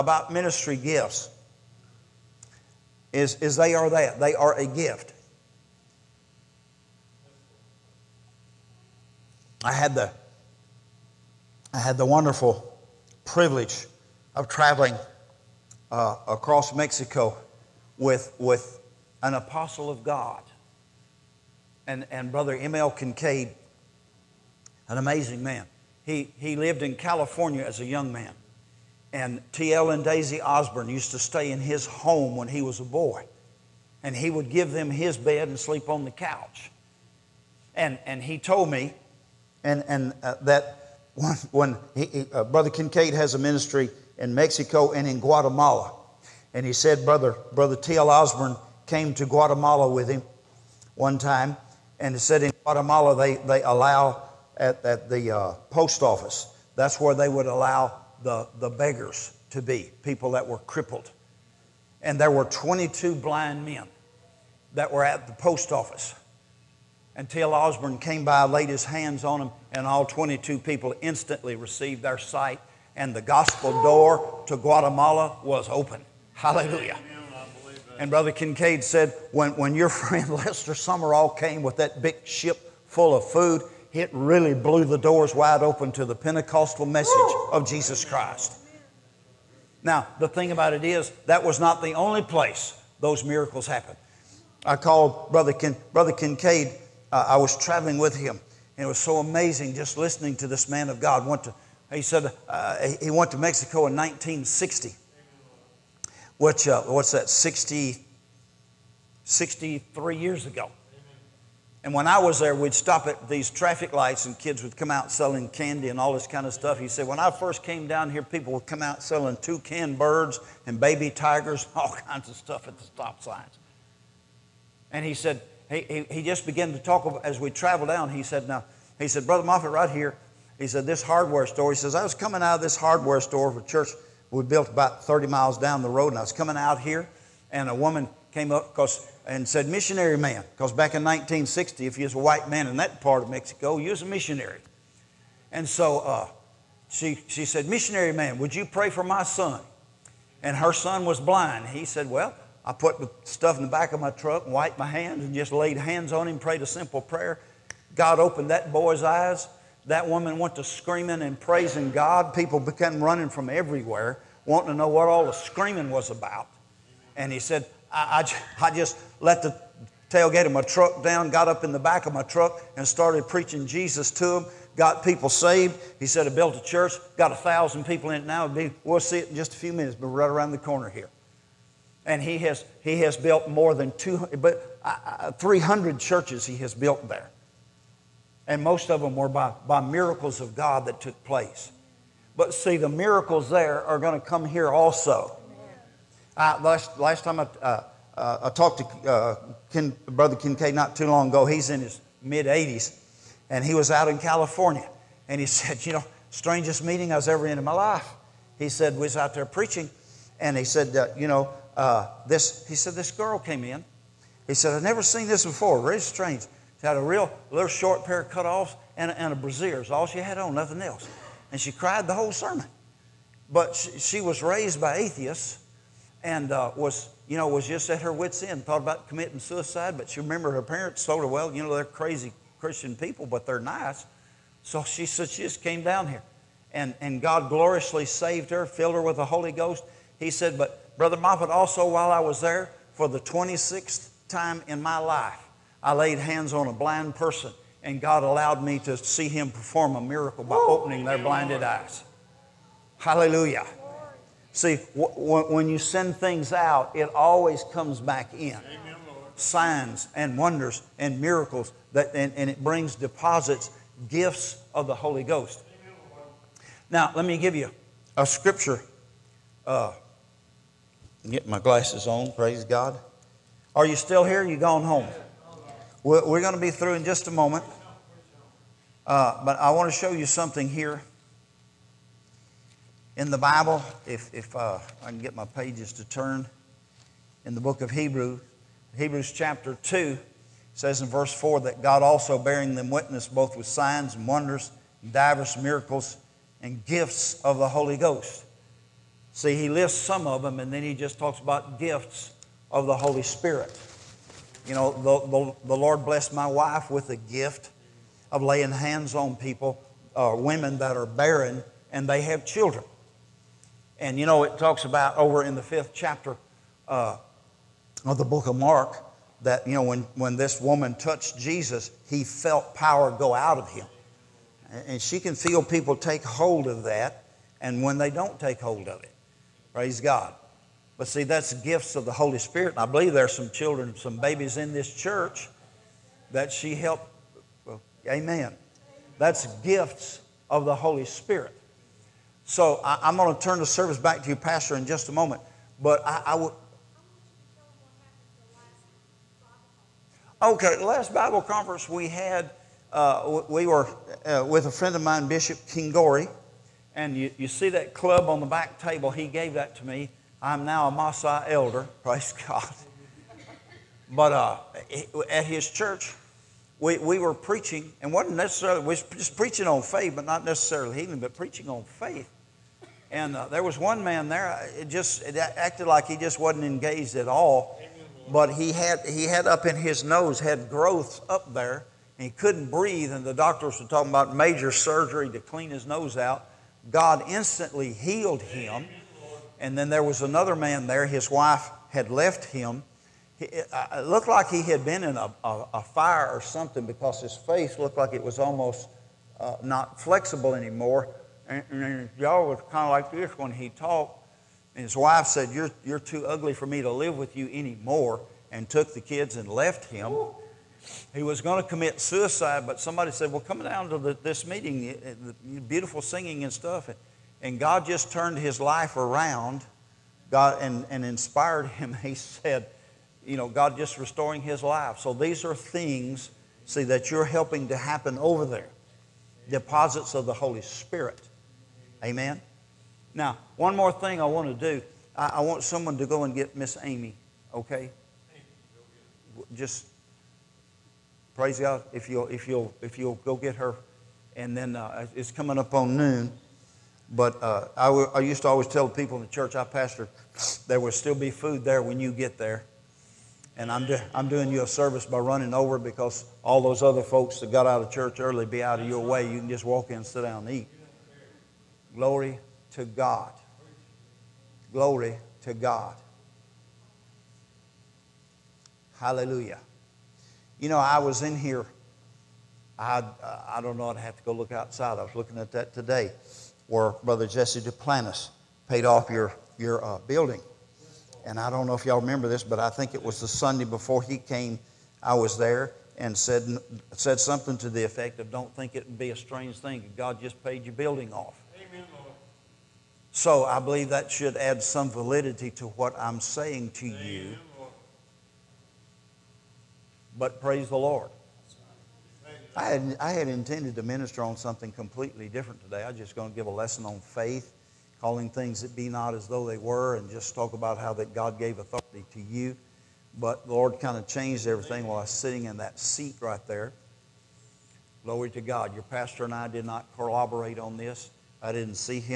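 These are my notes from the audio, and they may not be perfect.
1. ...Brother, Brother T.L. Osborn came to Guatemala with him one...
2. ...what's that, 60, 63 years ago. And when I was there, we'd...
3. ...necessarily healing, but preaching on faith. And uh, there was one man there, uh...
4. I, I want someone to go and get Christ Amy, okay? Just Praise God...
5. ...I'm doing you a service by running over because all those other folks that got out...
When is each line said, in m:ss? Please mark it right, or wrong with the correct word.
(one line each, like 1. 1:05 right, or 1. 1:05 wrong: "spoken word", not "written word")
1. 0:47 right
2. 1:46 right
3. 6:10 right
4. 7:15 wrong: "Miss", not "Christ"
5. 7:34 right.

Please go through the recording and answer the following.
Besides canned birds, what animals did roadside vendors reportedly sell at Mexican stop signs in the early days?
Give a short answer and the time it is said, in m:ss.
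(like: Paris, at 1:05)
baby tigers, at 2:00.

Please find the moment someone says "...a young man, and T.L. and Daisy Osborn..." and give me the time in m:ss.
0:27.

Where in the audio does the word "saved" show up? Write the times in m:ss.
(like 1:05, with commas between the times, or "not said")
2:55, 3:58.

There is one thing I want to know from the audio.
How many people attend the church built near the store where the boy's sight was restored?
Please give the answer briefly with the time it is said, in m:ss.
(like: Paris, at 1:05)
1,000, at 2:57.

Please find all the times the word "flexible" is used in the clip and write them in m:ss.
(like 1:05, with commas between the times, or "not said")
6:39.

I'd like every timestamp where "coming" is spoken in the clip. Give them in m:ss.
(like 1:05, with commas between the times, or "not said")
2:12, 2:16, 7:25.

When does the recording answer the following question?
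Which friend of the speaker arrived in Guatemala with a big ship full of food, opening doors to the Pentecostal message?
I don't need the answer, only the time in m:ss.
1:20.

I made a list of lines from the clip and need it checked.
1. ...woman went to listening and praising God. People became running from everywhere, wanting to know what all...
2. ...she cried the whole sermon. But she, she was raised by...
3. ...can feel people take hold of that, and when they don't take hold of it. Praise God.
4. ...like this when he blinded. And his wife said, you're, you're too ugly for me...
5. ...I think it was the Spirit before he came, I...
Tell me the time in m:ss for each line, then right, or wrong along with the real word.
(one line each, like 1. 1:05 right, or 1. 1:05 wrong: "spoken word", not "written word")
1. 2:40 wrong: "screaming", not "listening"
2. 3:41 right
3. 5:25 right
4. 6:42 wrong: "talked", not "blinded"
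5. 8:02 wrong: "Sunday", not "Spirit".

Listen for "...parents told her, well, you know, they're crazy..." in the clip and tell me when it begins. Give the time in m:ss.
3:50.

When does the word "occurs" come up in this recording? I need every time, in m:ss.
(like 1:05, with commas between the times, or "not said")
not said.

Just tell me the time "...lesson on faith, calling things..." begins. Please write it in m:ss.
8:26.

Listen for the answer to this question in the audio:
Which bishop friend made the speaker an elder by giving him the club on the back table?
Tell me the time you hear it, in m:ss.
5:55.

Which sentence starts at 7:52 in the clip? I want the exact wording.
I, I don't know, I'd have to go look outside.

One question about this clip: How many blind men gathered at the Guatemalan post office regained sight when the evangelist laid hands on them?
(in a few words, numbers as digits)
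22.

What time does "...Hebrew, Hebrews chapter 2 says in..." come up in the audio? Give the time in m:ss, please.
4:47.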